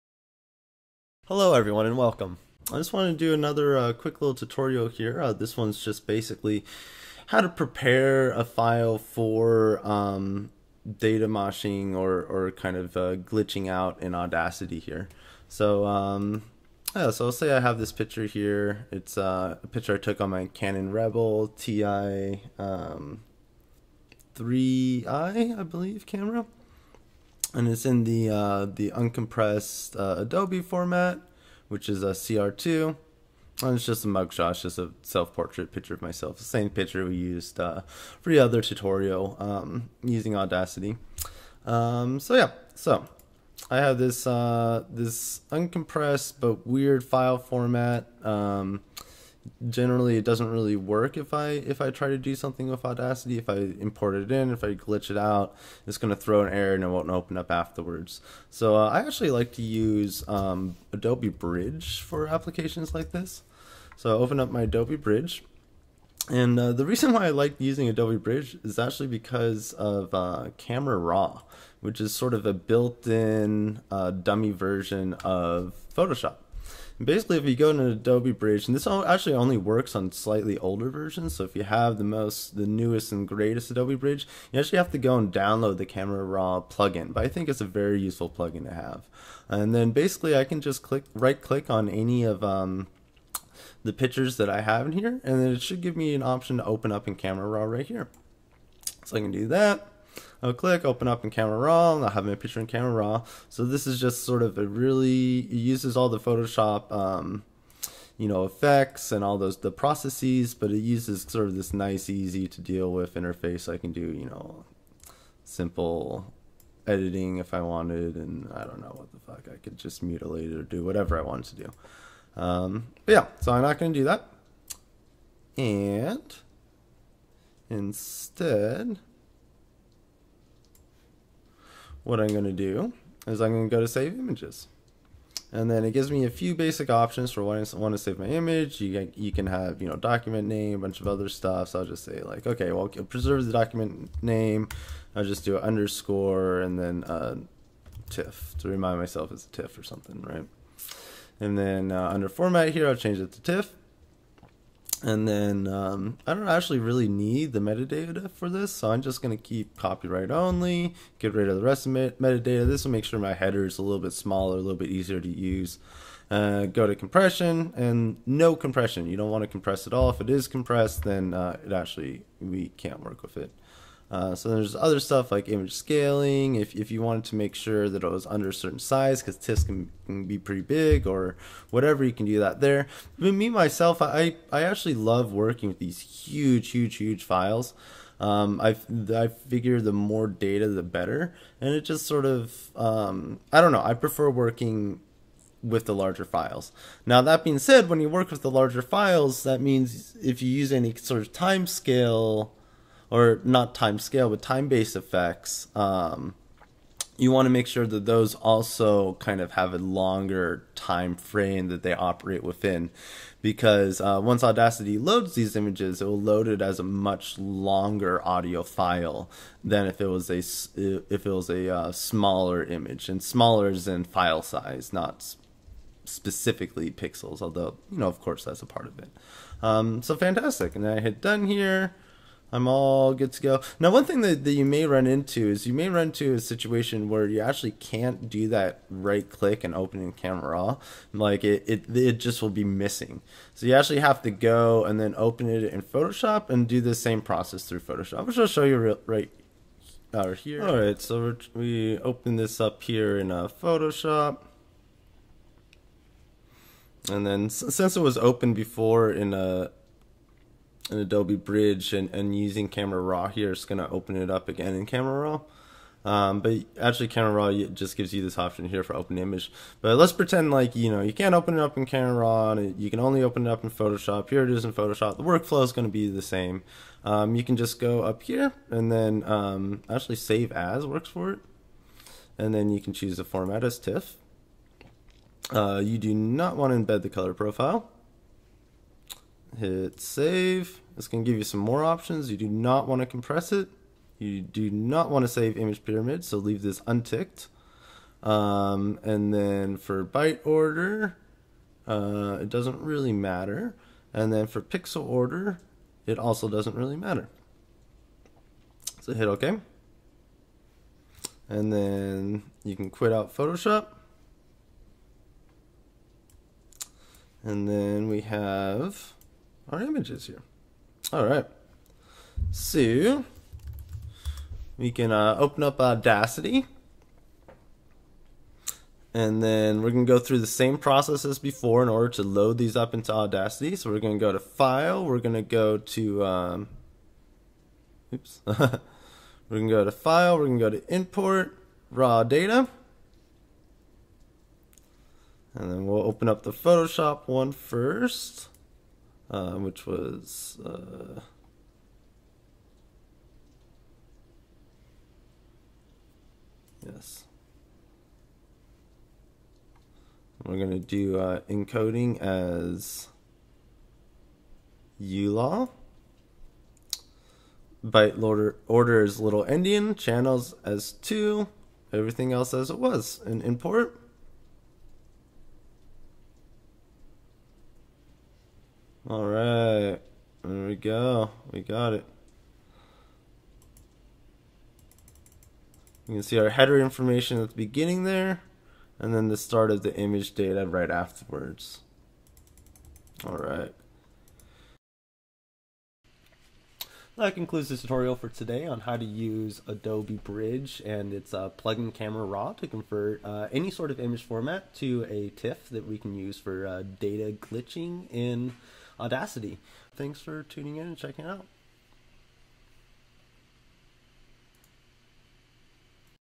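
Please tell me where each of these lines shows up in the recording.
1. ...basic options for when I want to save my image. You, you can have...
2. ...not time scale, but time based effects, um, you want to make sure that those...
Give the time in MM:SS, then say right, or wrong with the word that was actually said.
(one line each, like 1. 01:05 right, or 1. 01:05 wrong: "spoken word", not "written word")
1. 02:16 right
2. 03:23 right.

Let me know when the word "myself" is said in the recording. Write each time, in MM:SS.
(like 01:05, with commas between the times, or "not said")
00:36, 02:28, 03:03.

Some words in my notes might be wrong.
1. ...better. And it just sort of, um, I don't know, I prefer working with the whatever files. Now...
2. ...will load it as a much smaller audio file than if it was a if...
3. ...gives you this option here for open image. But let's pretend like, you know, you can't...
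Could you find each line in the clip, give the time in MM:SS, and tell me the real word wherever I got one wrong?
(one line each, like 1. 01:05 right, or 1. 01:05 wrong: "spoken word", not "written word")
1. 03:10 wrong: "larger", not "whatever"
2. 03:36 wrong: "longer", not "smaller"
3. 04:27 right.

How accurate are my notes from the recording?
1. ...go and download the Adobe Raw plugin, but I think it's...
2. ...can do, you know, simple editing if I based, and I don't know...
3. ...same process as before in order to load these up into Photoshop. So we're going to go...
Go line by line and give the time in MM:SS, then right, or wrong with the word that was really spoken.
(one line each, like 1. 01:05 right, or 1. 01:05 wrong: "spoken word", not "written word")
1. 01:24 wrong: "Camera", not "Adobe"
2. 01:53 wrong: "wanted", not "based"
3. 05:30 wrong: "Audacity", not "Photoshop".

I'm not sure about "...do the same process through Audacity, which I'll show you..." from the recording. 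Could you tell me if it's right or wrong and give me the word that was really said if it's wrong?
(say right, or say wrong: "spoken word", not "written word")
wrong: "Photoshop", not "Audacity".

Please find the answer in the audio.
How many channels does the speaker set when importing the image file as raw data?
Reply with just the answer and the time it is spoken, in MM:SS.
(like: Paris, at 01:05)
2, at 06:10.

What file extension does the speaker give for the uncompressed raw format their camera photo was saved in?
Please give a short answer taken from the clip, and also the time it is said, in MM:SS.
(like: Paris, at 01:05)
CR2, at 00:32.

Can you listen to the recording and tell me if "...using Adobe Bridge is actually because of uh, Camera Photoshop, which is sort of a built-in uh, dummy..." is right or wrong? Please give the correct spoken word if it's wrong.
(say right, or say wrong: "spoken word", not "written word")
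wrong: "Raw", not "Photoshop".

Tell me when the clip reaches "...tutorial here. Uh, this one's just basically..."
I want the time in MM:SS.
00:04.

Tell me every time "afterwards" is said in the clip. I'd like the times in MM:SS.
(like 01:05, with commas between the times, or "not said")
00:57, 06:30.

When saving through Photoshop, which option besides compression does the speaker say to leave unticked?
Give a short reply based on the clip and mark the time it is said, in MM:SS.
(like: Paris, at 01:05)
Image pyramid, at 04:55.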